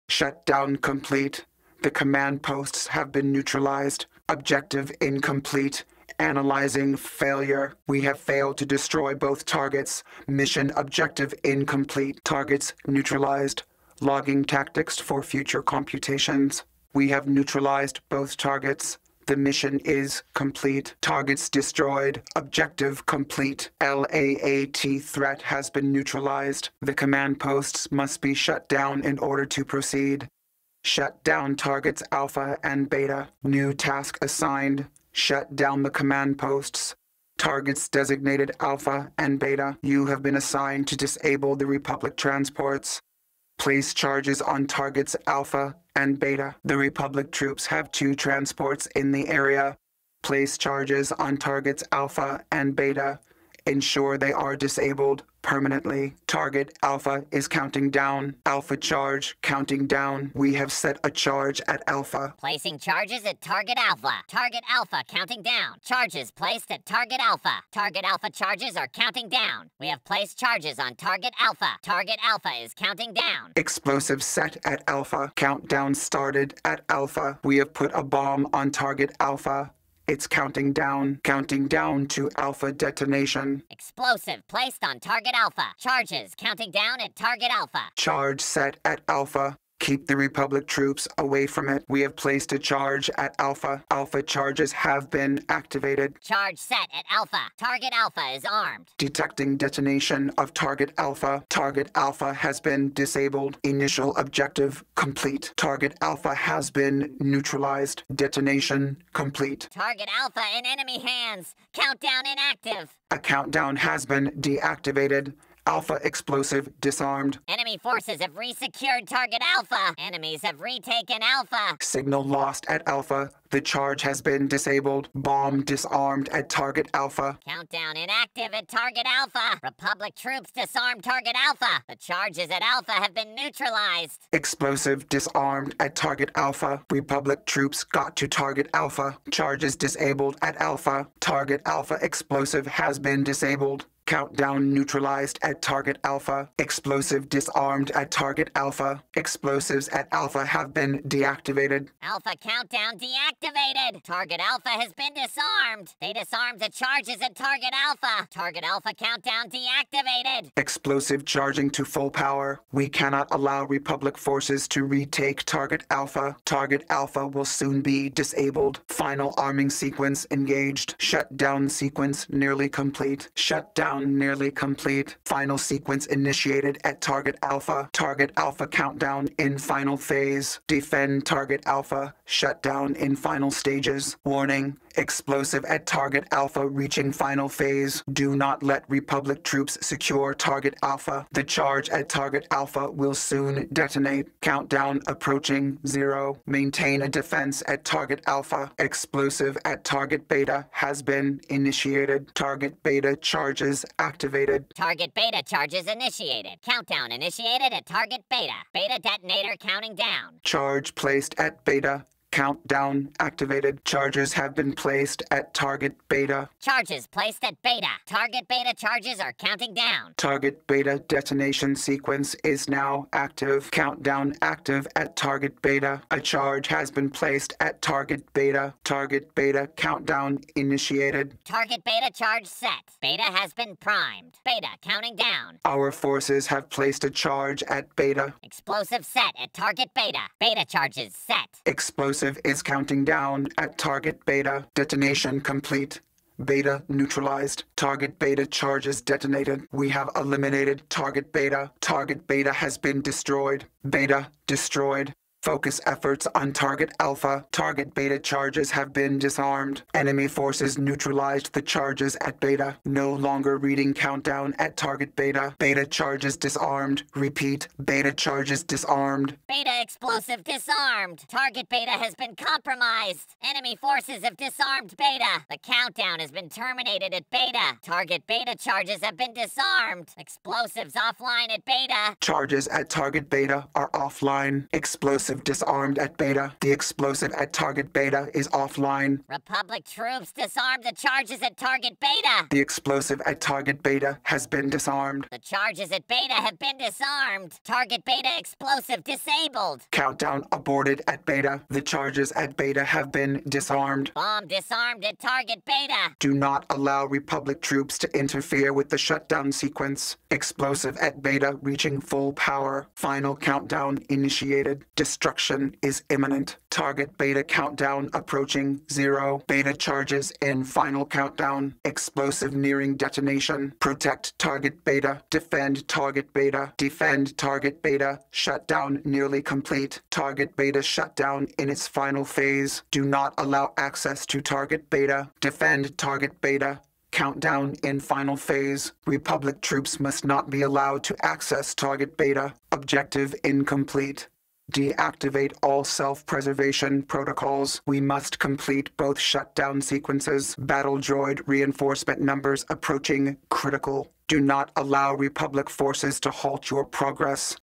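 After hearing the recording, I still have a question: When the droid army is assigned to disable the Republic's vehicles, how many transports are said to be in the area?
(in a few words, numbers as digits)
2.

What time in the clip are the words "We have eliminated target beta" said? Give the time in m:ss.
4:09.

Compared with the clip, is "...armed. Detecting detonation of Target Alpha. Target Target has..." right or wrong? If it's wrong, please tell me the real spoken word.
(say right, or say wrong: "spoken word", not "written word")
wrong: "Alpha", not "Target".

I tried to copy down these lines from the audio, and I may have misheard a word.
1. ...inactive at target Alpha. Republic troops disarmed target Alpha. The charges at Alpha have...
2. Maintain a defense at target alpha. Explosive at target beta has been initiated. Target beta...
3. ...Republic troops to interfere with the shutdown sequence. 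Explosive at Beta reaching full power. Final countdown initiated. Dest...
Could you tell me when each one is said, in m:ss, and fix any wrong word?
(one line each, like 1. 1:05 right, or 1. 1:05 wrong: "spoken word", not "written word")
1. 2:07 right
2. 3:16 right
3. 5:07 right.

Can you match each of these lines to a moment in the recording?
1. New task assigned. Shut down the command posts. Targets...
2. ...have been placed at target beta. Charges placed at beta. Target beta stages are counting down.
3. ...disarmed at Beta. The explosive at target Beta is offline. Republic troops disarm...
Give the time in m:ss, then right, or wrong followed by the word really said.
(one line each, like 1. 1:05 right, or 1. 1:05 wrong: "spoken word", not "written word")
1. 0:33 right
2. 3:34 wrong: "charges", not "stages"
3. 4:45 right.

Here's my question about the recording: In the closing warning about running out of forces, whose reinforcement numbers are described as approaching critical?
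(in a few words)
battle droid.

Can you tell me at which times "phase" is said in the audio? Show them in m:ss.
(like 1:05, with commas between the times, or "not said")
2:59, 3:07, 5:32, 5:38.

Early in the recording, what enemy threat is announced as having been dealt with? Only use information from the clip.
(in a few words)
LAAT.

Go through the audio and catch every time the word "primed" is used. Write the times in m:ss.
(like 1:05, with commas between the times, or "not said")
3:53.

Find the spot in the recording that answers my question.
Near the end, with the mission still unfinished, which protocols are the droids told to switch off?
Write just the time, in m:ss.
5:45.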